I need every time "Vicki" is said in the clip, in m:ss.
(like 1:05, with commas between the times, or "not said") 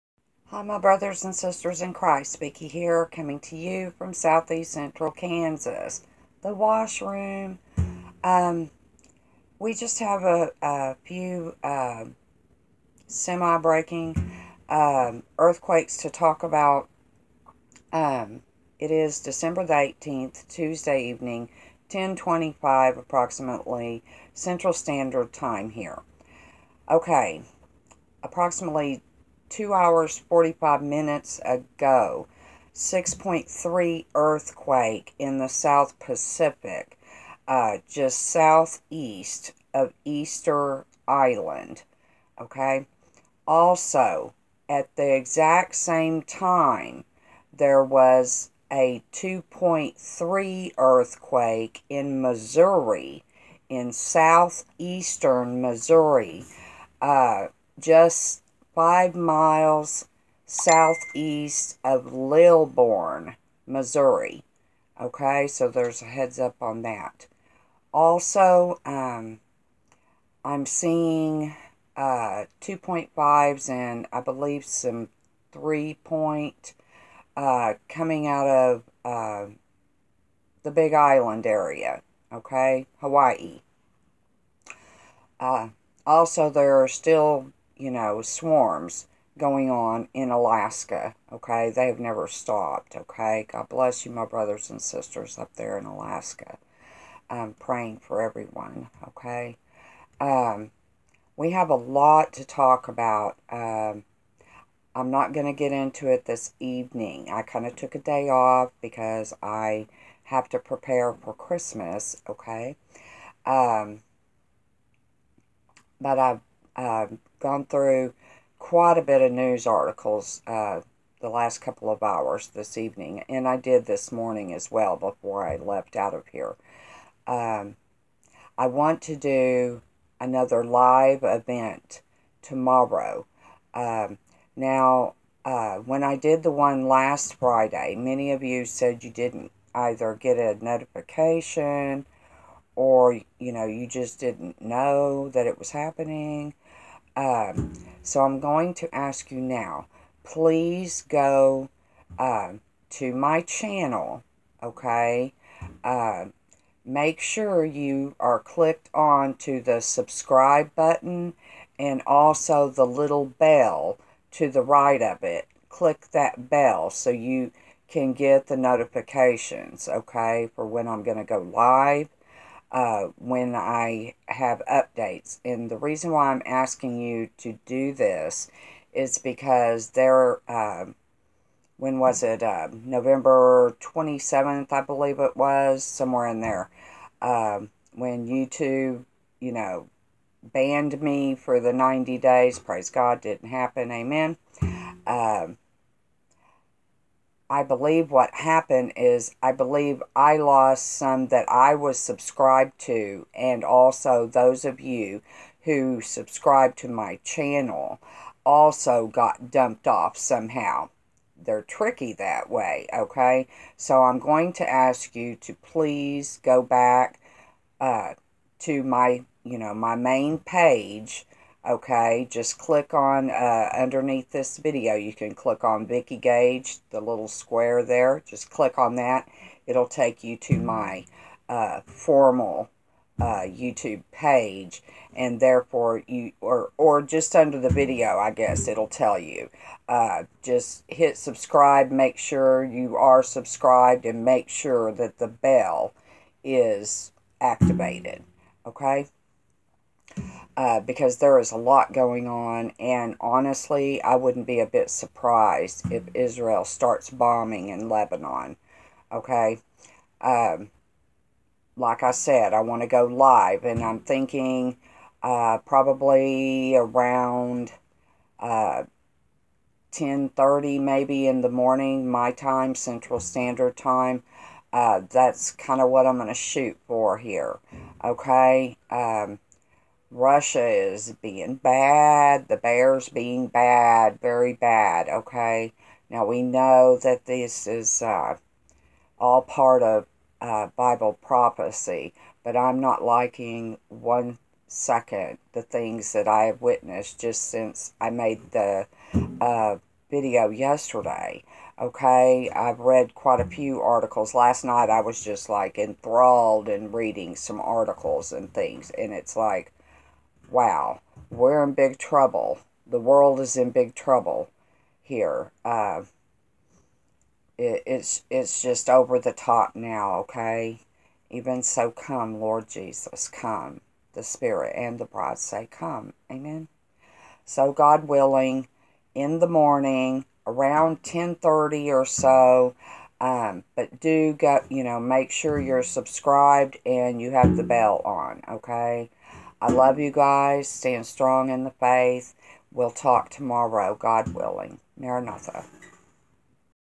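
0:02, 3:45.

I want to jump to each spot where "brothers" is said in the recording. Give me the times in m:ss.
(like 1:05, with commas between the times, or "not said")
0:00, 1:34.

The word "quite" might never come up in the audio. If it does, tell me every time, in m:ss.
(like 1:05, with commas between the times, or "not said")
1:58, 5:03.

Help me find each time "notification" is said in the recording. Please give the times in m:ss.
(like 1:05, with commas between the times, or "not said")
2:20, 2:48.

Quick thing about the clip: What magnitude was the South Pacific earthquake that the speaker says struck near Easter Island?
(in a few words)
6.3.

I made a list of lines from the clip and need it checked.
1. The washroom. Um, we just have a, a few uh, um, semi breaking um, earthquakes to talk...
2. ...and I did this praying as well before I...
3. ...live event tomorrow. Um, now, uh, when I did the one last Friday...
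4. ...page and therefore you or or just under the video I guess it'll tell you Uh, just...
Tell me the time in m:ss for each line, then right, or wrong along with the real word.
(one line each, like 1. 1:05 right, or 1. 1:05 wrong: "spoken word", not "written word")
1. 0:06 right
2. 2:03 wrong: "morning", not "praying"
3. 2:10 right
4. 3:54 right.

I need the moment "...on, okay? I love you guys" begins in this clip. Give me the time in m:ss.
5:38.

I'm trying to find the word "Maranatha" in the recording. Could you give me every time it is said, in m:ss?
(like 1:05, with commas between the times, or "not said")
5:44.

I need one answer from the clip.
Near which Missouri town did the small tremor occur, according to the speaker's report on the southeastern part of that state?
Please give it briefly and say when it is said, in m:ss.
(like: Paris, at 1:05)
Lilbourn, at 1:02.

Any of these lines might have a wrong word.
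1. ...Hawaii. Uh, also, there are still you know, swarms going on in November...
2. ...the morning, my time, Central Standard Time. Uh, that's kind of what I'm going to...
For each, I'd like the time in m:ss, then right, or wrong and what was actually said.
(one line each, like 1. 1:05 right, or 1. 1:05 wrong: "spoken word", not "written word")
1. 1:22 wrong: "Alaska", not "November"
2. 4:31 right.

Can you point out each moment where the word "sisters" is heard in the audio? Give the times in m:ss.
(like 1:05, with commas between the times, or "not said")
0:01, 1:34.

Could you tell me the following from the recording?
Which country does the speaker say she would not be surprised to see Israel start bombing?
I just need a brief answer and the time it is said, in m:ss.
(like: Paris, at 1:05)
Lebanon, at 4:17.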